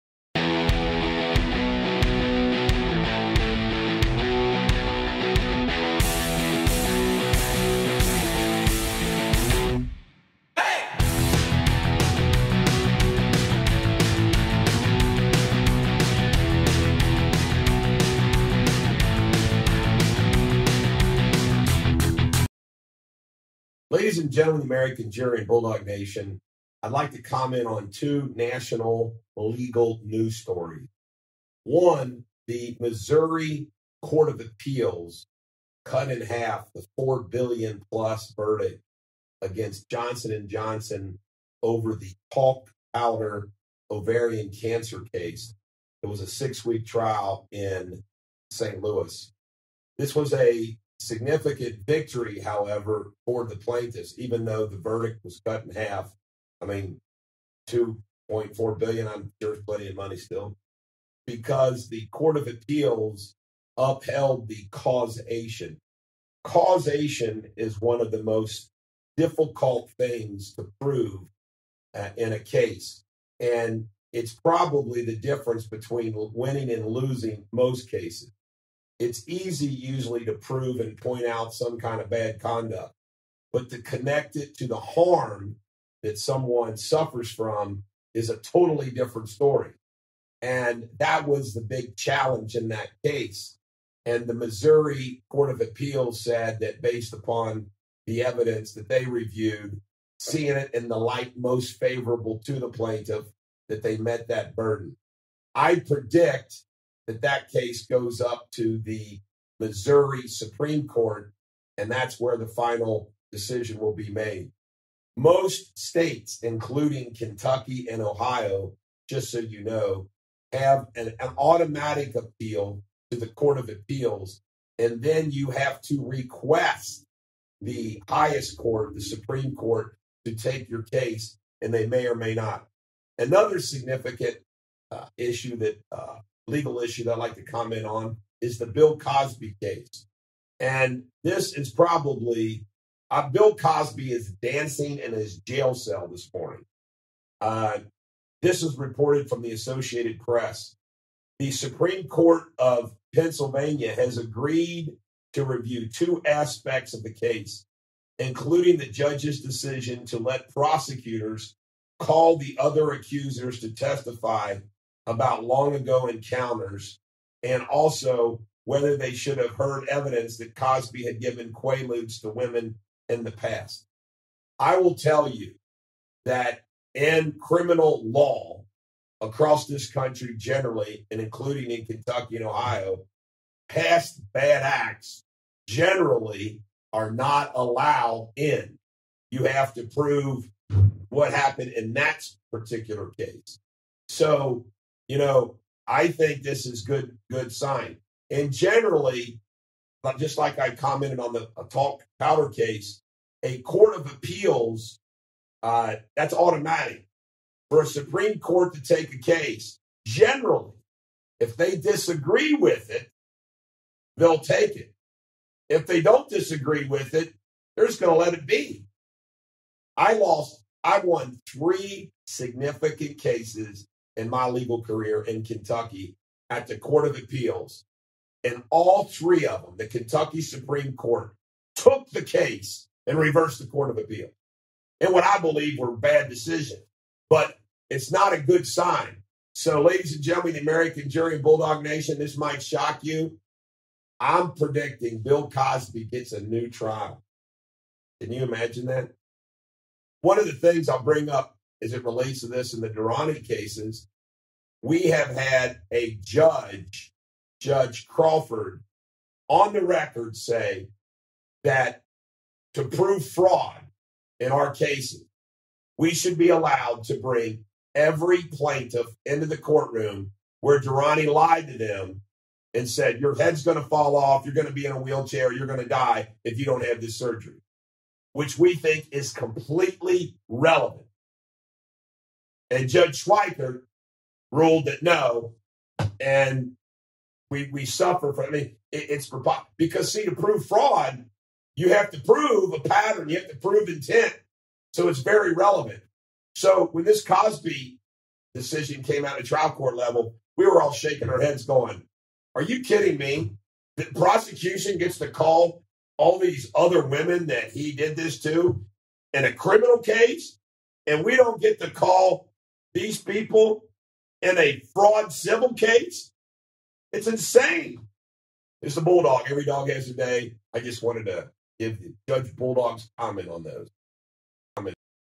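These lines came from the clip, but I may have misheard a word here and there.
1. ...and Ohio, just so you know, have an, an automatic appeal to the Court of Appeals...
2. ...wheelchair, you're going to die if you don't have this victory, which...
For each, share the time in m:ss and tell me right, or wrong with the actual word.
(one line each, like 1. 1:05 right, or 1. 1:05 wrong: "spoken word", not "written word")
1. 1:57 right
2. 4:35 wrong: "surgery", not "victory".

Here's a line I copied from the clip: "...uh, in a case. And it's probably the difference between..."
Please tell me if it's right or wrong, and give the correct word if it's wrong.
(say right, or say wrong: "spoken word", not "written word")
right.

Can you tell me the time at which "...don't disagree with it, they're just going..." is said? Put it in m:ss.
3:35.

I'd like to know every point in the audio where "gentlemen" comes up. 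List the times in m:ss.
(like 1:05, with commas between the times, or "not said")
0:24, 4:00.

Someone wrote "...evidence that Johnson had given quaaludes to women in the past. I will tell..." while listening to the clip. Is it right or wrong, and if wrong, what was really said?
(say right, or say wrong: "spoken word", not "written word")
wrong: "Cosby", not "Johnson".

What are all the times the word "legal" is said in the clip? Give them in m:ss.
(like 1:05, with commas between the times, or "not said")
0:29, 2:16, 3:44.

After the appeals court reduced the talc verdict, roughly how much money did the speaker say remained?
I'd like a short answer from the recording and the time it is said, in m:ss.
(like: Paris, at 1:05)
2.4 billion, at 0:57.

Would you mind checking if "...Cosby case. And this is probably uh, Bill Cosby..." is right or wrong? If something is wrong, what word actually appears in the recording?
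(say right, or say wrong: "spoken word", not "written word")
right.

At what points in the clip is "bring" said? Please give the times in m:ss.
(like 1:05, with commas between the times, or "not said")
4:11, 4:27.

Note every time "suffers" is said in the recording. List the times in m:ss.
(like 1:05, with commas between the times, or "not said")
1:26, 4:47.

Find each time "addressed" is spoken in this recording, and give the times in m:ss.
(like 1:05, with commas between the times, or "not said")
not said.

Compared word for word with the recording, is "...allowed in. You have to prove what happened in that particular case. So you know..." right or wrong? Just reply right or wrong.
right.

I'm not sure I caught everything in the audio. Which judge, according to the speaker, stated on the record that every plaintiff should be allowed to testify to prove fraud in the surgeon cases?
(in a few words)
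Judge Crawford.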